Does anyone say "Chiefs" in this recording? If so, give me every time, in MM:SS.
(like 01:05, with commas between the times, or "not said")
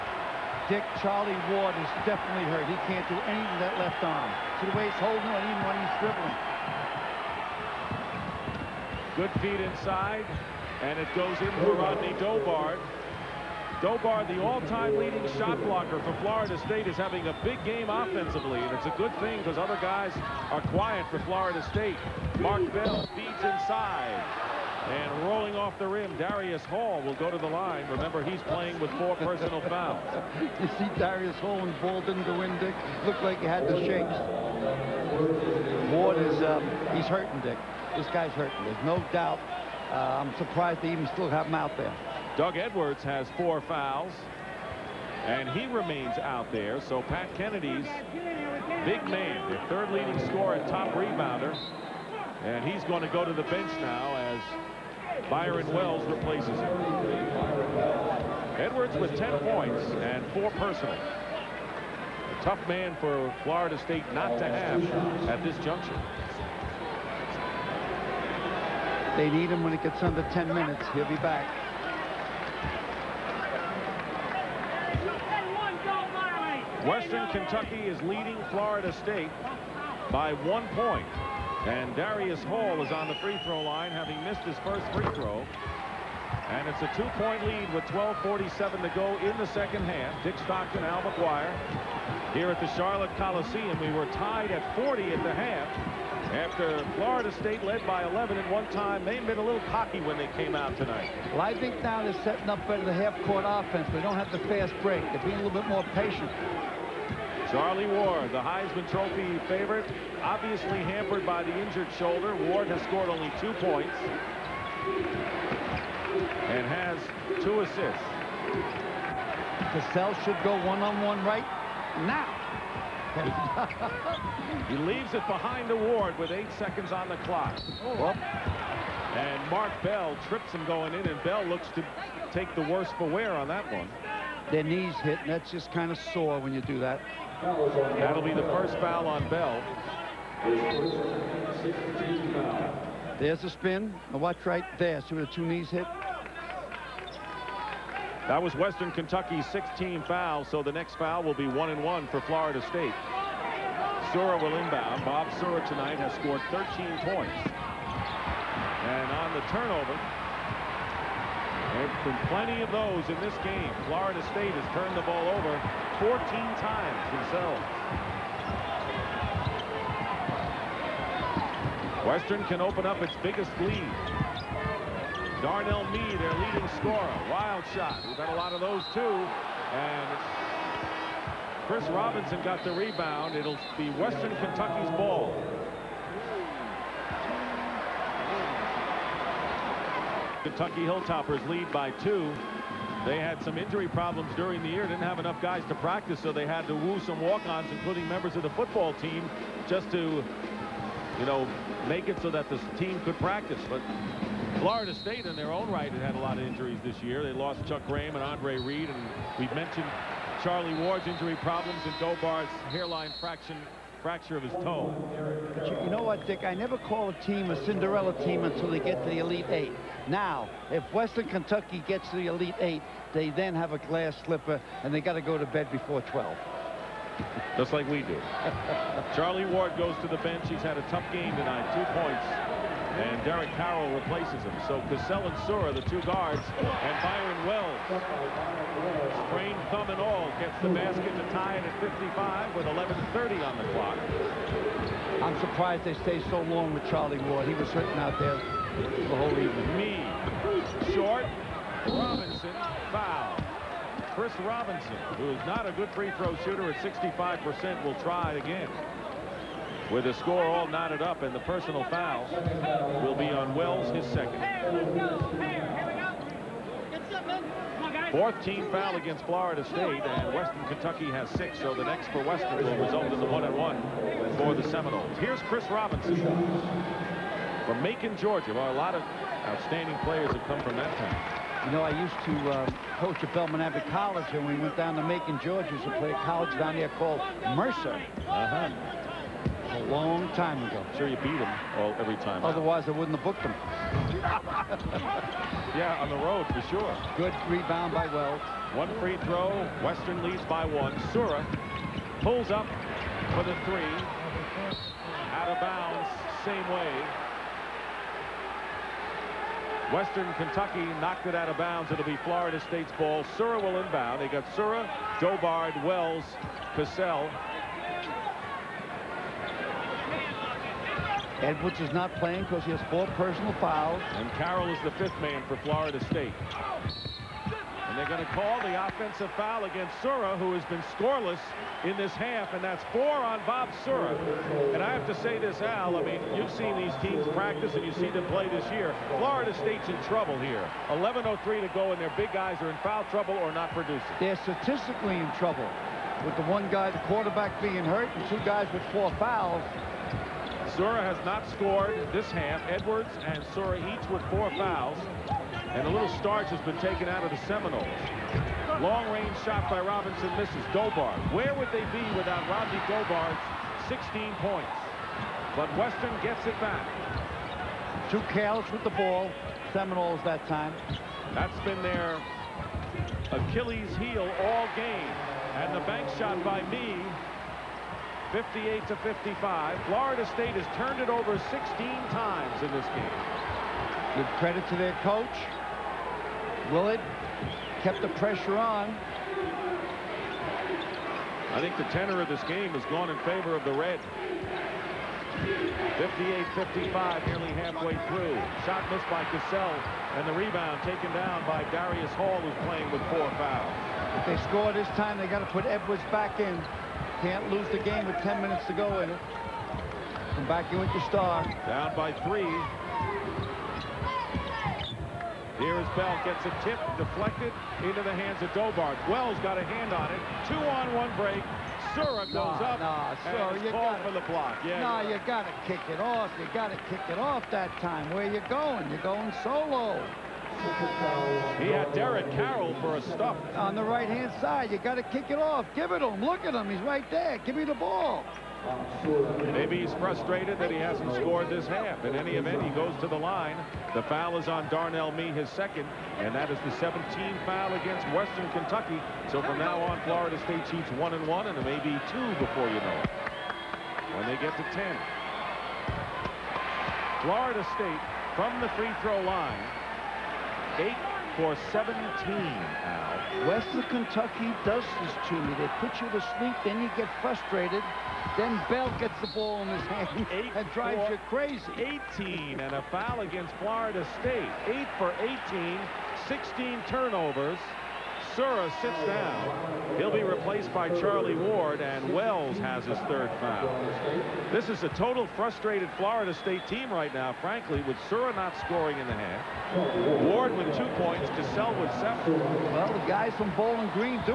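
07:30.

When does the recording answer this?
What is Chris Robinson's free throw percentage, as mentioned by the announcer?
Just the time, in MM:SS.
04:16.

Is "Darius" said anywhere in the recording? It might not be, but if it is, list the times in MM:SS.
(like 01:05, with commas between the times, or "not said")
00:26, 00:30, 01:21, 06:41.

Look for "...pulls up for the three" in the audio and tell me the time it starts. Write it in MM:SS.
05:02.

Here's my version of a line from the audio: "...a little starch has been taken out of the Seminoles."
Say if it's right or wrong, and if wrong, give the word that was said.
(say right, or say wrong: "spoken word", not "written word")
right.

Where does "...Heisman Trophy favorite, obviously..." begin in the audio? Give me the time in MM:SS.
01:48.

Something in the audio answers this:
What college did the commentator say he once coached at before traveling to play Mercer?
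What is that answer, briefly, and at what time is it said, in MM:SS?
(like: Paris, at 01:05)
Belmont Abbey College, at 04:43.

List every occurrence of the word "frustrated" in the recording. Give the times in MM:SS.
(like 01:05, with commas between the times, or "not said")
07:19, 07:47, 08:05.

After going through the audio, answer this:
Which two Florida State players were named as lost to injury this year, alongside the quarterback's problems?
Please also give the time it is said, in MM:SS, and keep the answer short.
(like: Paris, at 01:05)
Chuck Graham and Andre Reed, at 03:27.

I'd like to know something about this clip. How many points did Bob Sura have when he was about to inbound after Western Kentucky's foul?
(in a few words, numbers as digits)
13.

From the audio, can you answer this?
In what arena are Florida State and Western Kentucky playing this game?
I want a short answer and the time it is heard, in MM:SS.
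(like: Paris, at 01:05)
Charlotte Coliseum, at 01:32.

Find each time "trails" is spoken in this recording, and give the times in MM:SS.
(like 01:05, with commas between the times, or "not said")
not said.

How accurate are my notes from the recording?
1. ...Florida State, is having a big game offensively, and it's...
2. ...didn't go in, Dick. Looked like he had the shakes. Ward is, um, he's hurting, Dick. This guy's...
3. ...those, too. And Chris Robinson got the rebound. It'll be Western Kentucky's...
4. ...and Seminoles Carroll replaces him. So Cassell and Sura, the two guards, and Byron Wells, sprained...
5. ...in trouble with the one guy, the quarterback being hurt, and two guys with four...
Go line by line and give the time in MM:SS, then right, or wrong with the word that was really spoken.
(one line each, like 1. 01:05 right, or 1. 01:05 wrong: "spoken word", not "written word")
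1. 00:16 right
2. 00:32 right
3. 02:58 right
4. 03:53 wrong: "Derek", not "Seminoles"
5. 05:45 right.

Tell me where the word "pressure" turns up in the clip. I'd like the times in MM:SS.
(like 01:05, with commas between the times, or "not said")
06:28.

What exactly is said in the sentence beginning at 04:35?
Here's Chris Robinson from Macon, Georgia.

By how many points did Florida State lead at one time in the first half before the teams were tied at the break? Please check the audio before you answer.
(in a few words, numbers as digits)
11.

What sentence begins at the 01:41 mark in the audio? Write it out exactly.
Well, I think now they're setting up better the half-court offense.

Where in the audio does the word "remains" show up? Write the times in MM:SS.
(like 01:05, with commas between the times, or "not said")
00:45.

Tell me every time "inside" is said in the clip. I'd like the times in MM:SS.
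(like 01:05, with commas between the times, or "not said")
00:09, 00:23.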